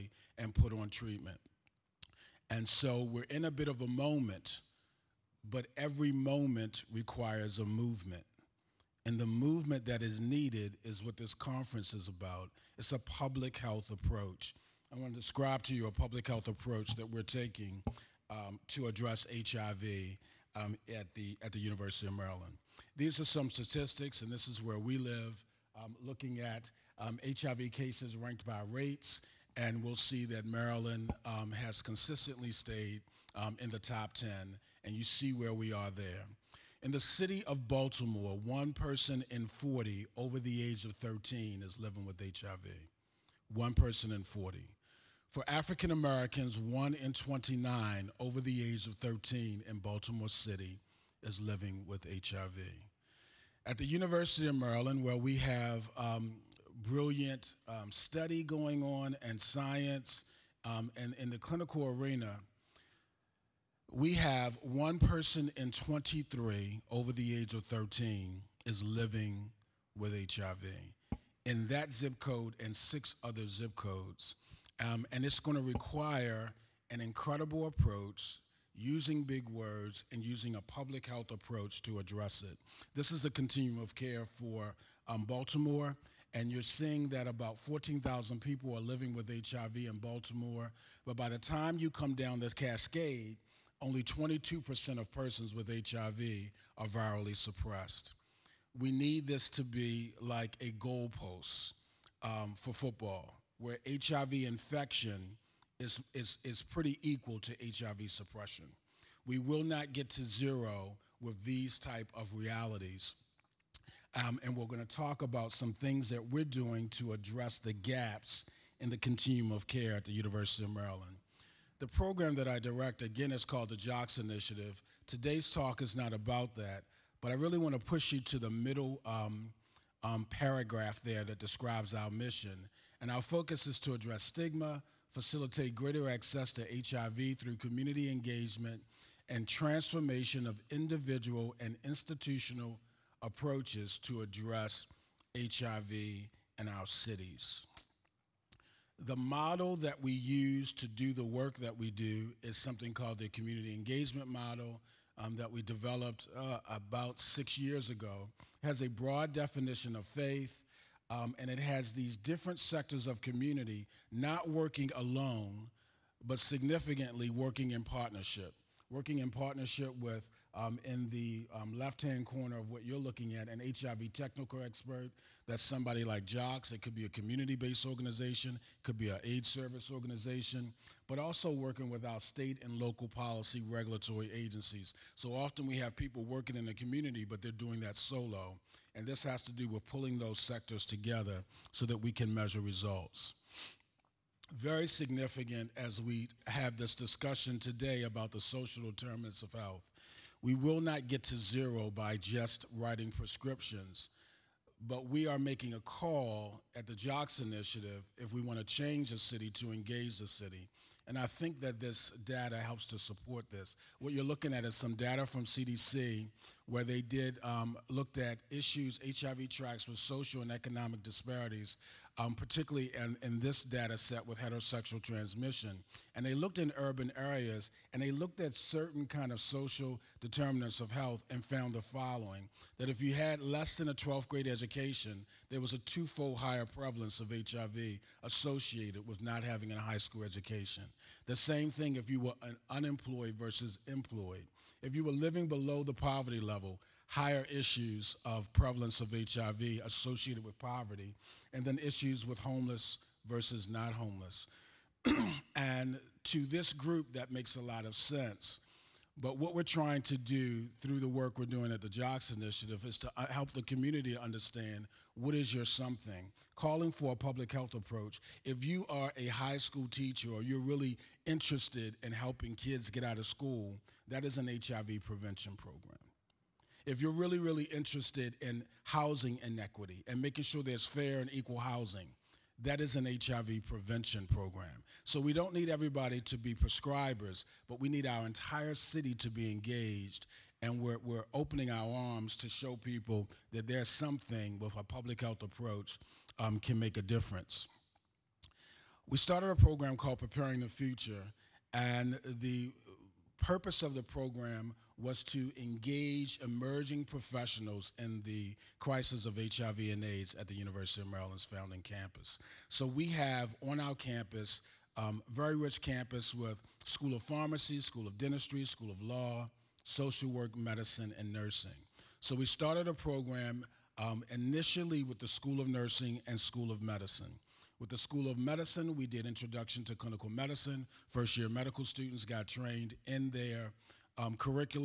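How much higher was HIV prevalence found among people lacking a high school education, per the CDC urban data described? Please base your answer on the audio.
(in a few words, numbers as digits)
twofold.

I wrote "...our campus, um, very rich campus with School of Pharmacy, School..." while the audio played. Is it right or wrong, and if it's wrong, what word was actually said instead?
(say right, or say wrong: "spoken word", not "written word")
right.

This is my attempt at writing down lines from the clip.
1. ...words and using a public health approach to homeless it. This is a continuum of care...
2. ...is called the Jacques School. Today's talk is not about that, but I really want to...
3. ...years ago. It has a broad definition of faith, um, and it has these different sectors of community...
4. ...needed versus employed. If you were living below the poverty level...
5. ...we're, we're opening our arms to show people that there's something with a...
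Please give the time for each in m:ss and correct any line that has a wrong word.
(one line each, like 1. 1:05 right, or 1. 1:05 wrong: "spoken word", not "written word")
1. 1:19 wrong: "address", not "homeless"
2. 2:03 wrong: "Initiative", not "School"
3. 2:37 right
4. 4:02 wrong: "unemployed", not "needed"
5. 4:50 right.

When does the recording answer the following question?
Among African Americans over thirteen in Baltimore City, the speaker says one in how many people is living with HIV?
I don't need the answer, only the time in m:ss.
0:46.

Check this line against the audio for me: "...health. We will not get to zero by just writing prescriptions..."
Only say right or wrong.
right.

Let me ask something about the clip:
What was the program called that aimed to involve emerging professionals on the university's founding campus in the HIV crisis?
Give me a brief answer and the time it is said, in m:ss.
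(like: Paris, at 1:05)
Preparing the Future, at 5:00.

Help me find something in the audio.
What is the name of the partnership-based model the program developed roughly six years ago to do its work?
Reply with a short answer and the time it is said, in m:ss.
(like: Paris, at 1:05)
community engagement model, at 2:33.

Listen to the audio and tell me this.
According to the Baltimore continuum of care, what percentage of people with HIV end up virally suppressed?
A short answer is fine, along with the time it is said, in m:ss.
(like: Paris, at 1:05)
22%, at 1:34.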